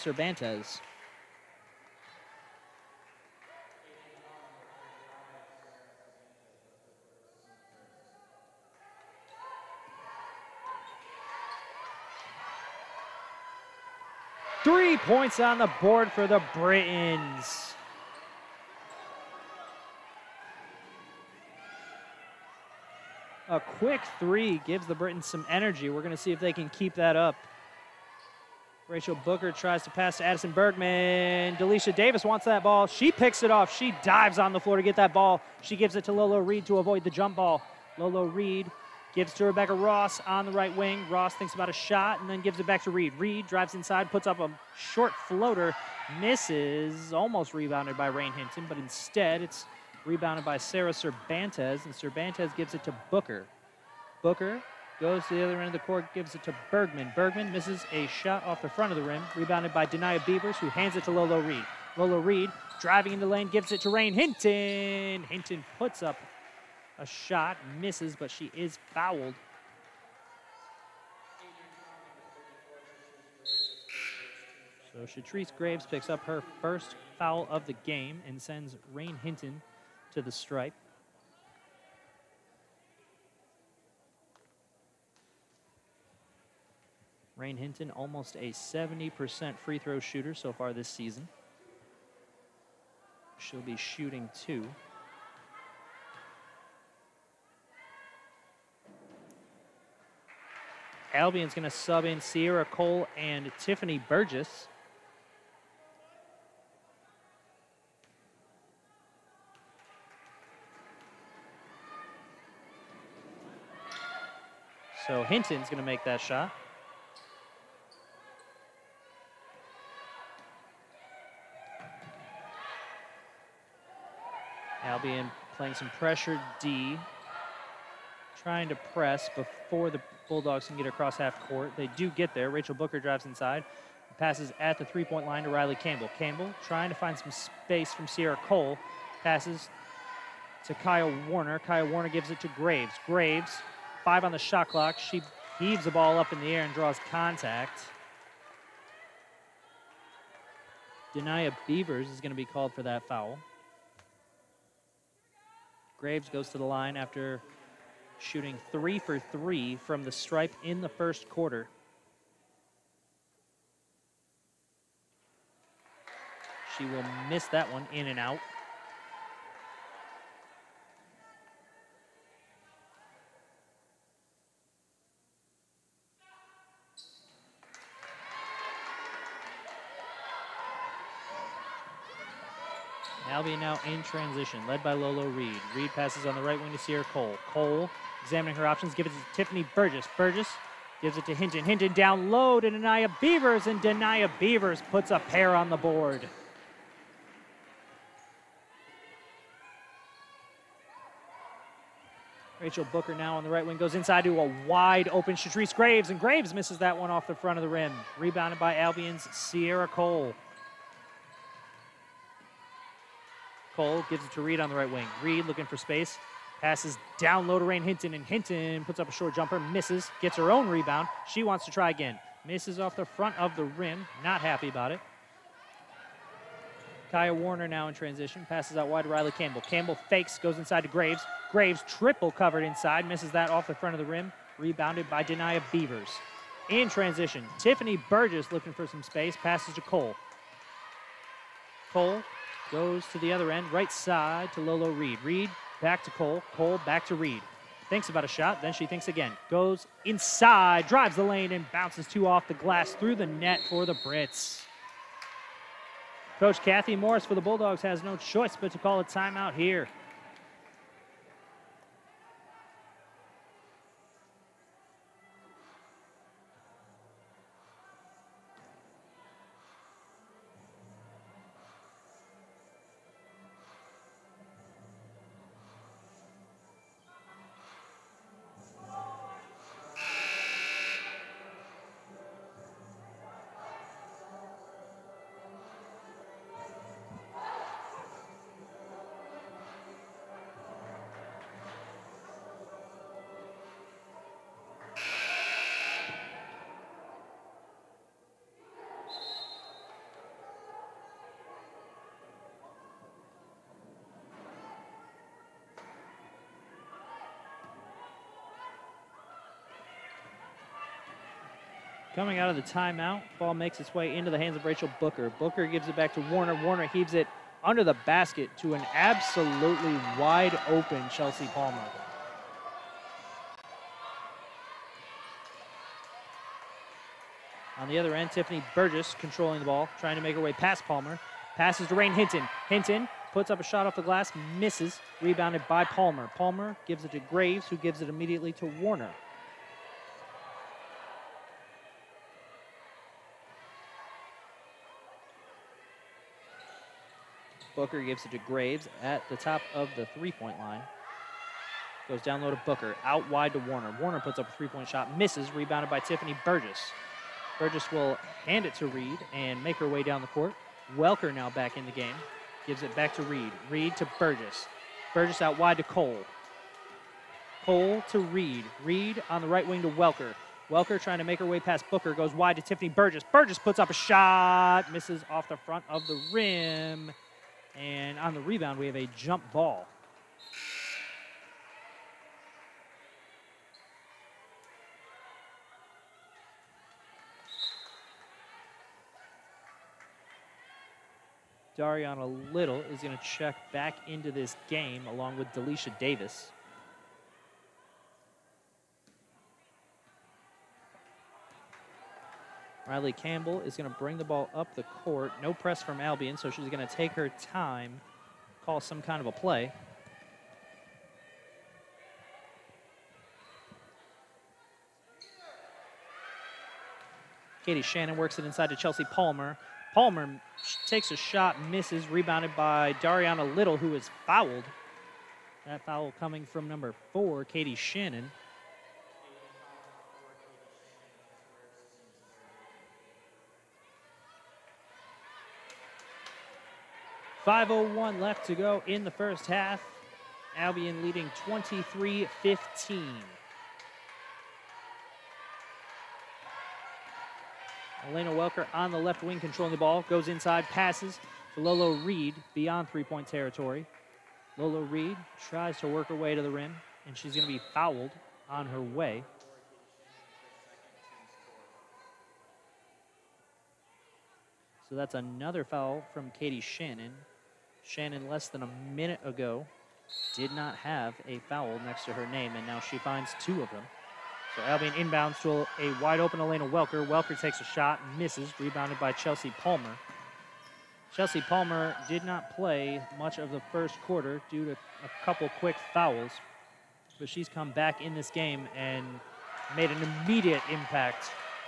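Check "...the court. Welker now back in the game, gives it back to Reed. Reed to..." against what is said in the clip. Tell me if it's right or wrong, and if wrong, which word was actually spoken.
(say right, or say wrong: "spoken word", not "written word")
right.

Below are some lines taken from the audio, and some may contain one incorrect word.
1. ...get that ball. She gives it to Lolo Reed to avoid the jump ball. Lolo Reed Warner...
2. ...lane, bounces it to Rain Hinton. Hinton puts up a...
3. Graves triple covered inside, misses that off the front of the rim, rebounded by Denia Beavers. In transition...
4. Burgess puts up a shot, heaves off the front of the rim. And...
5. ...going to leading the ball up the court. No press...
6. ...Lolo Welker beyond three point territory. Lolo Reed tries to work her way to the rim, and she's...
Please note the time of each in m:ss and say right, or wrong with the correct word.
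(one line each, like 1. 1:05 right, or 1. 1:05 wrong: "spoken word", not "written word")
1. 0:34 wrong: "Gives", not "Warner"
2. 1:03 wrong: "gives", not "bounces"
3. 3:51 right
4. 6:13 wrong: "misses", not "heaves"
5. 6:43 wrong: "bring", not "leading"
6. 7:31 wrong: "Reed", not "Welker".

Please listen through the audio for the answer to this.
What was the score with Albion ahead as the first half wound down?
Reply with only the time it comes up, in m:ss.
7:21.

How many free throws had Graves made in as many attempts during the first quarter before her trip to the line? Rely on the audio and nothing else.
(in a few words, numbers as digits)
3.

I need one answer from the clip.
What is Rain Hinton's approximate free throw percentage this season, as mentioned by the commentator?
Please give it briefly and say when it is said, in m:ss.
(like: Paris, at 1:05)
70%, at 1:28.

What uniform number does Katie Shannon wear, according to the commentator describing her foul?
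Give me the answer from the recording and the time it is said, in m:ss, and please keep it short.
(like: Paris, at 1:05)
4, at 7:06.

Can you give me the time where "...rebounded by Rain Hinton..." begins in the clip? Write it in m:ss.
0:47.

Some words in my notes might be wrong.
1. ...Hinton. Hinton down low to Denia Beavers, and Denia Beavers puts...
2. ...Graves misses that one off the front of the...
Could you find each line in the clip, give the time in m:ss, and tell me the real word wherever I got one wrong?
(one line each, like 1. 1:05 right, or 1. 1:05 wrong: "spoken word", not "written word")
1. 3:11 right
2. 3:26 right.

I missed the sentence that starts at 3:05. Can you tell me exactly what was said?
Reed passes on the right wing to Sierra Cole.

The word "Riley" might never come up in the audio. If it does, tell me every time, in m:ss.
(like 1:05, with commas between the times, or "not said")
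2:15, 3:49, 6:42.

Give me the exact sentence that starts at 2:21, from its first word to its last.
Kaya Warner gives it to Graves.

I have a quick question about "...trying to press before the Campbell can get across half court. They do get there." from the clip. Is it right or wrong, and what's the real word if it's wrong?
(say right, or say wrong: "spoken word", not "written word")
wrong: "Bulldogs", not "Campbell".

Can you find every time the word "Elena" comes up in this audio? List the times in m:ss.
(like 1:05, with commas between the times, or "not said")
7:28, 7:56.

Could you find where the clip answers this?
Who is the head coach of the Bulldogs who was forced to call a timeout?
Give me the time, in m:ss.
4:16.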